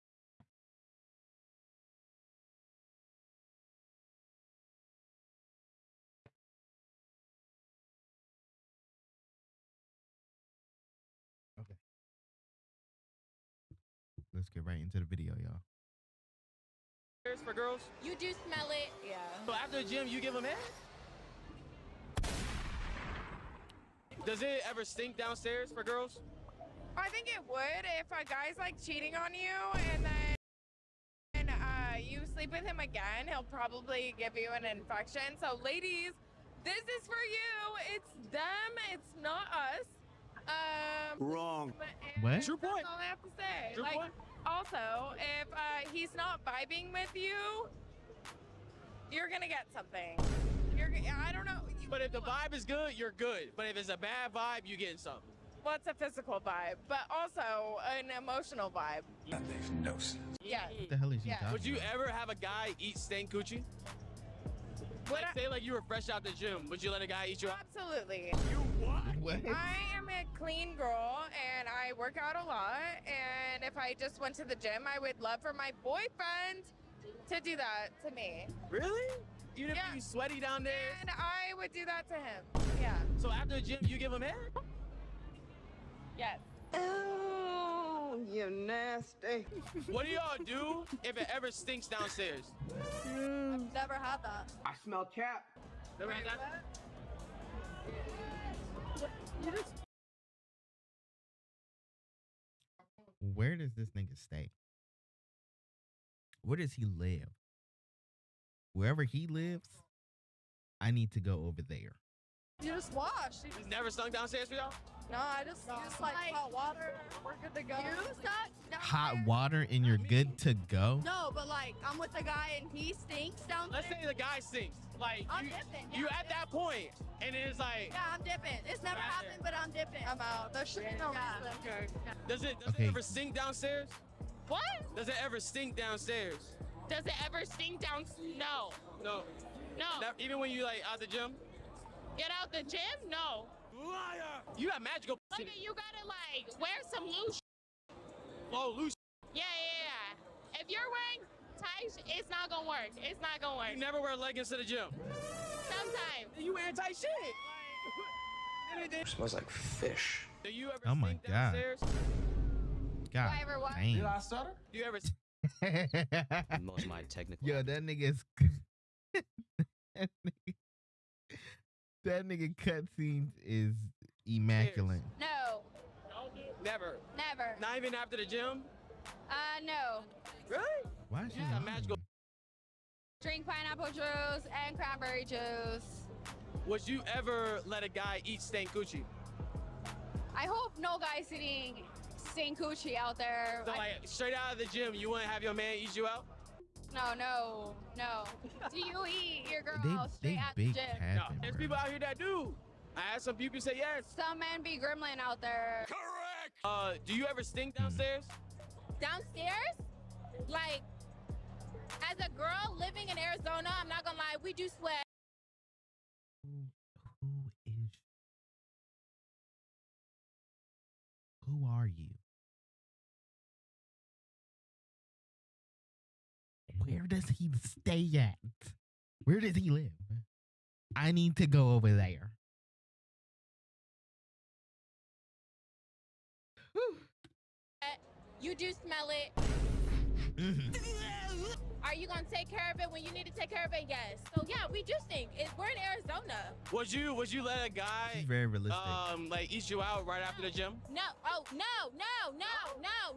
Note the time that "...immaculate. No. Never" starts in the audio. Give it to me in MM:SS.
02:54.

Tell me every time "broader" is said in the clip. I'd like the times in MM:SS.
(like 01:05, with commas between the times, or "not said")
not said.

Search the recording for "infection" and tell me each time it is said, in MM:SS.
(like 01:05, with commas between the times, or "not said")
00:34.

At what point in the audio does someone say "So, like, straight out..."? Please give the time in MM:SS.
03:13.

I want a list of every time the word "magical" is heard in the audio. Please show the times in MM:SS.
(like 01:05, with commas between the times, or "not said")
02:24, 03:01.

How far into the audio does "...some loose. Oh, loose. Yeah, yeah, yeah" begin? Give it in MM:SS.
02:26.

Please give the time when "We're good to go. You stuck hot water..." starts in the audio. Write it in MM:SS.
01:57.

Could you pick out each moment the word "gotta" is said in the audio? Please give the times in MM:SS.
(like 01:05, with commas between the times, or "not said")
02:25.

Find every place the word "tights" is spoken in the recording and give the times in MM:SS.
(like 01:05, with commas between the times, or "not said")
02:31, 02:36.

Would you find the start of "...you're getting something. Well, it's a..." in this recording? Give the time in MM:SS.
00:54.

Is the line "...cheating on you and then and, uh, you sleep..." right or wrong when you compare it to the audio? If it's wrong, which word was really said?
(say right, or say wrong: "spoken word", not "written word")
right.